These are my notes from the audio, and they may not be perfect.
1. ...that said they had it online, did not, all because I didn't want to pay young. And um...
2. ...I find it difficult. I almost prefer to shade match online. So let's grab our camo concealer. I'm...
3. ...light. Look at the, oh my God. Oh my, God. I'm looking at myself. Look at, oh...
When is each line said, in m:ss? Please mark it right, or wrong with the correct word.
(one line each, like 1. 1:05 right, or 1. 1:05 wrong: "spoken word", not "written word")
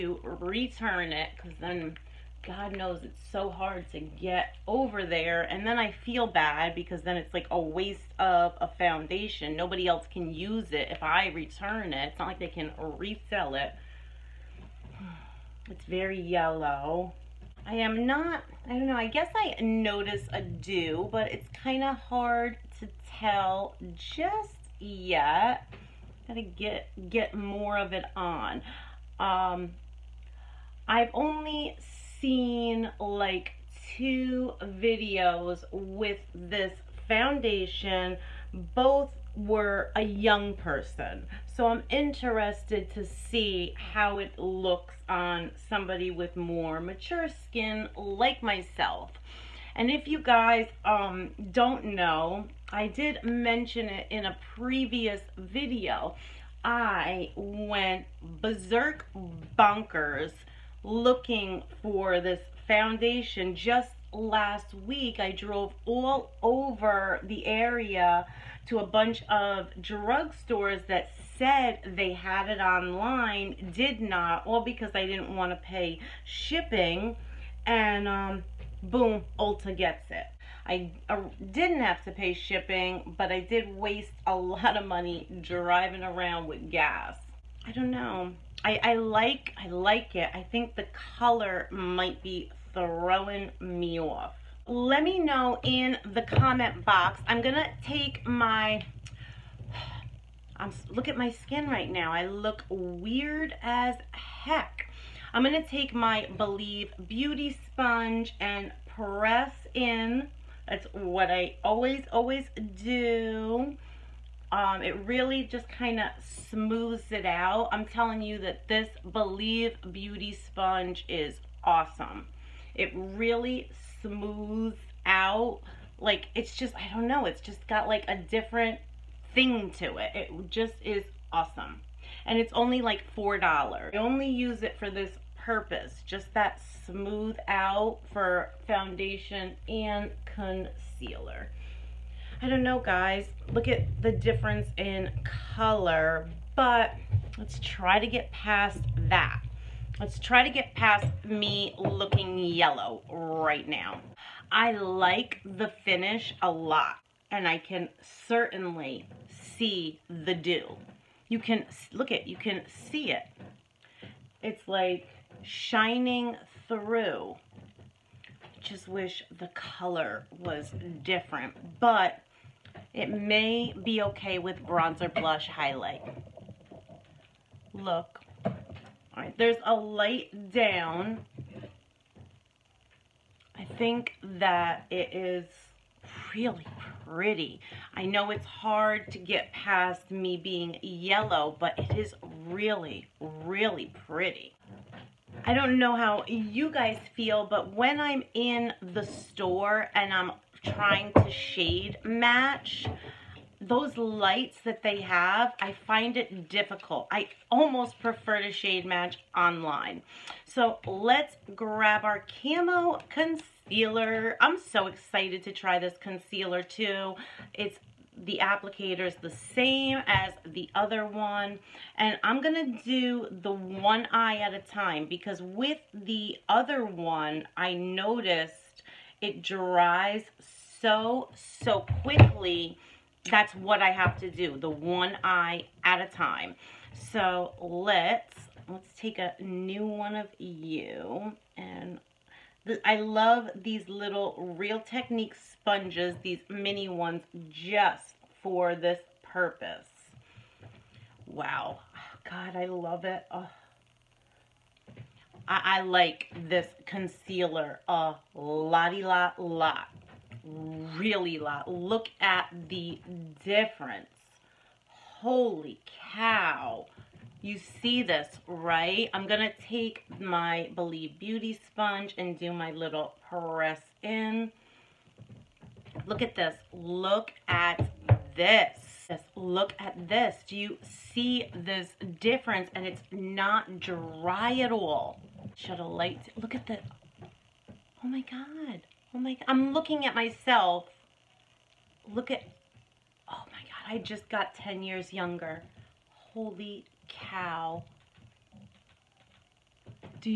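1. 1:10 wrong: "shipping", not "young"
2. 3:25 right
3. 4:45 right.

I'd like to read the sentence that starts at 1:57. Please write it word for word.
I'm telling you that this Believe Beauty Sponge is awesome.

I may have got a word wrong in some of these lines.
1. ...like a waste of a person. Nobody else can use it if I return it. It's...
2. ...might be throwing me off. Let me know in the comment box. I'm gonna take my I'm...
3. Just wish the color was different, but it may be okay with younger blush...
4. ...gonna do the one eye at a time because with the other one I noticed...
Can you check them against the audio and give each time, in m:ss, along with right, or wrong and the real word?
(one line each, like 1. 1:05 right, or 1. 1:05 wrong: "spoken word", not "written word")
1. 0:07 wrong: "foundation", not "person"
2. 1:31 right
3. 2:48 wrong: "bronzer", not "younger"
4. 3:42 right.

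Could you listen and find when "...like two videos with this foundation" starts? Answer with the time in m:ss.
0:32.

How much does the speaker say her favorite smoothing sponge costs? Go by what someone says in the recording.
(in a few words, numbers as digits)
$4.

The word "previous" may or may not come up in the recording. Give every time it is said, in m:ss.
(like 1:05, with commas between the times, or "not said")
0:54.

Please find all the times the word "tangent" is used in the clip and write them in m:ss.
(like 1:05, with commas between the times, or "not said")
not said.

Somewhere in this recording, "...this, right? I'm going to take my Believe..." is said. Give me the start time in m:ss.
4:28.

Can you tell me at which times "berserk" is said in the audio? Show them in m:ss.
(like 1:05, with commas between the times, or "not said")
0:58.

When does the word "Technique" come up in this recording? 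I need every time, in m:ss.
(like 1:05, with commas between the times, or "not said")
4:04.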